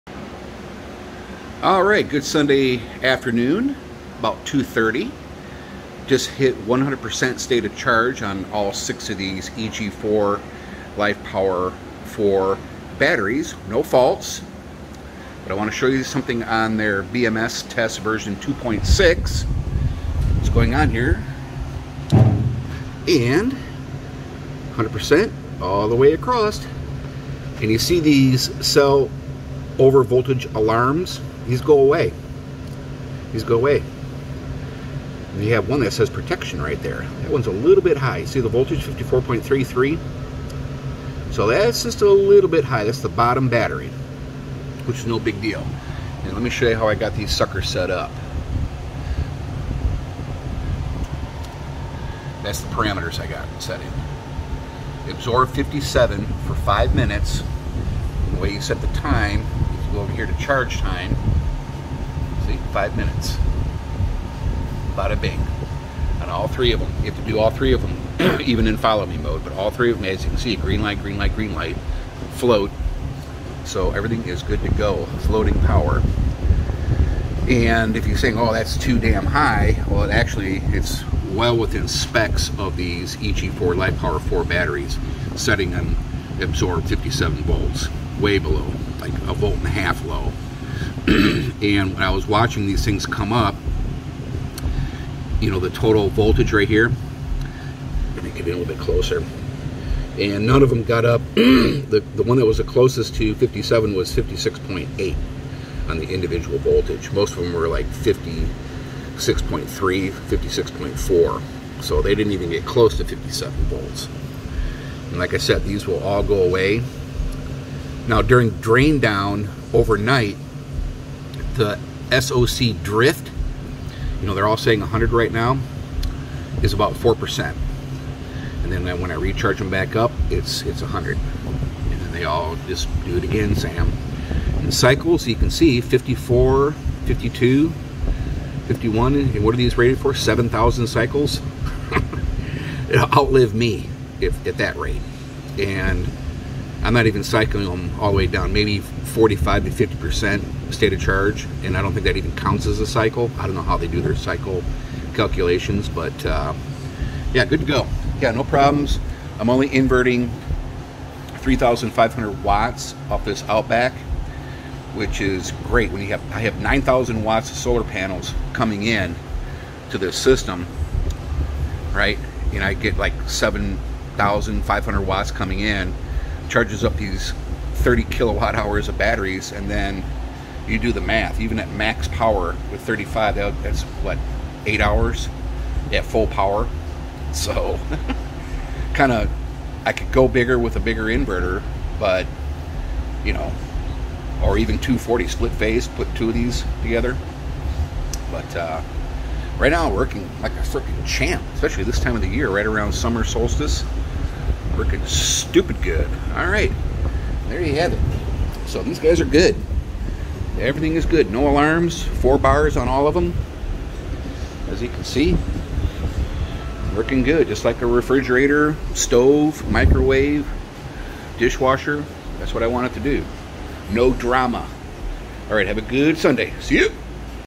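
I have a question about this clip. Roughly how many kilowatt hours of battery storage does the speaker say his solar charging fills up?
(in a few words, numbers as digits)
30 kilowatt hours.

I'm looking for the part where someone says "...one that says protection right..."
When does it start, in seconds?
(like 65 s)
35 s.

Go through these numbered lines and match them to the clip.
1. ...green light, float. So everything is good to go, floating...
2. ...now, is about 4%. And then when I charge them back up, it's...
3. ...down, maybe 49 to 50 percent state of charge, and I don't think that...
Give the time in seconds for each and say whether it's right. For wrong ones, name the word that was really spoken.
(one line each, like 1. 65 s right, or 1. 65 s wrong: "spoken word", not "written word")
1. 71 s right
2. 125 s wrong: "recharge", not "charge"
3. 148 s wrong: "45", not "49".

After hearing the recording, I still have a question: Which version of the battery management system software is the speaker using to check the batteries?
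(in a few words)
2.6.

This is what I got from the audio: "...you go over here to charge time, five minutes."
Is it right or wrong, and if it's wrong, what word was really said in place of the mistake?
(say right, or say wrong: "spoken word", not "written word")
right.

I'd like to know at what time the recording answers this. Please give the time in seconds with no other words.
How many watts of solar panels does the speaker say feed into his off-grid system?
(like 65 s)
166 s.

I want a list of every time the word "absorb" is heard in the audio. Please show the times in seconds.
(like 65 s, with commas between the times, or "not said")
55 s, 86 s.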